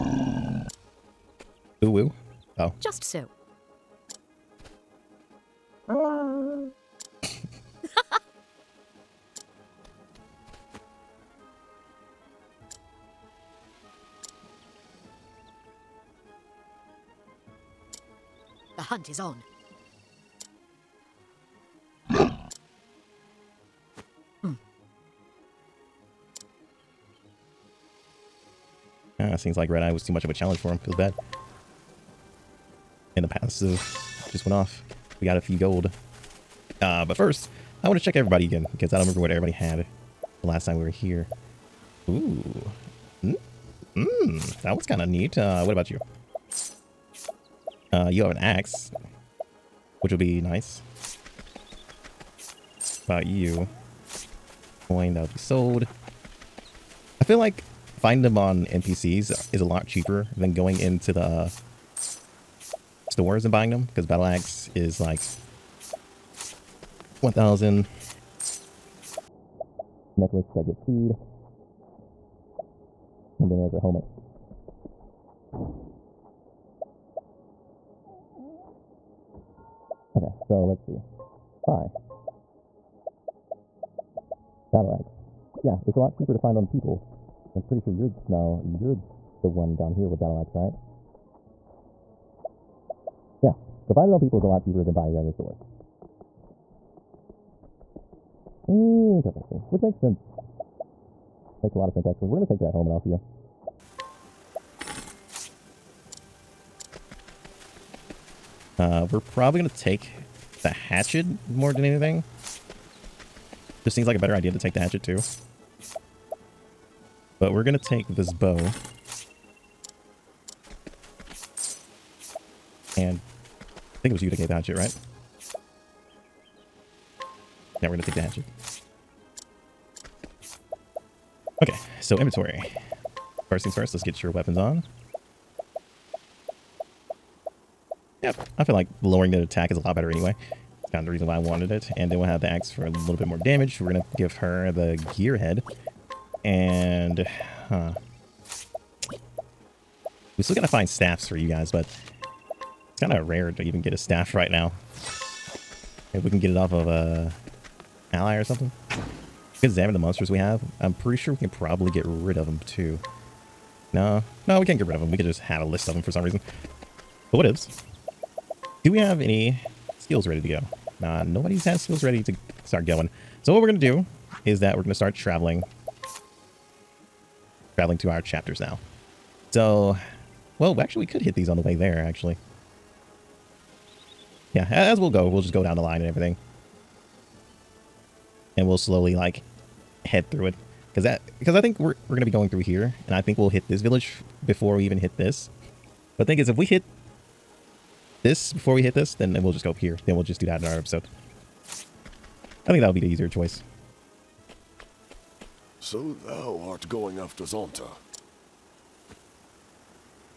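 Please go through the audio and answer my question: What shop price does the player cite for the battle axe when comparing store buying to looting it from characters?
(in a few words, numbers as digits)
1000.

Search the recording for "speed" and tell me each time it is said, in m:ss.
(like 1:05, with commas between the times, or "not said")
1:10.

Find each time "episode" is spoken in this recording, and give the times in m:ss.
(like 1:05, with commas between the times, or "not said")
3:20.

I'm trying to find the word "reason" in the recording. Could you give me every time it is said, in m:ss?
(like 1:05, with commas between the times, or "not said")
2:21, 2:46.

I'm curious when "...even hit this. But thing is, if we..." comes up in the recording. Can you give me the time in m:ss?
3:14.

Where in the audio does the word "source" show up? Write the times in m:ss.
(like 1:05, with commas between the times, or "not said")
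1:35.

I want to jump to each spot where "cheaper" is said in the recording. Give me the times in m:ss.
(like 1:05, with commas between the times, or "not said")
0:59, 1:26, 1:34.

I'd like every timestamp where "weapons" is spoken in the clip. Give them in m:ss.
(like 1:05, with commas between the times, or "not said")
2:14.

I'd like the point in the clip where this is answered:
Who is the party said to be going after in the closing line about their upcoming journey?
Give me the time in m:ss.
3:27.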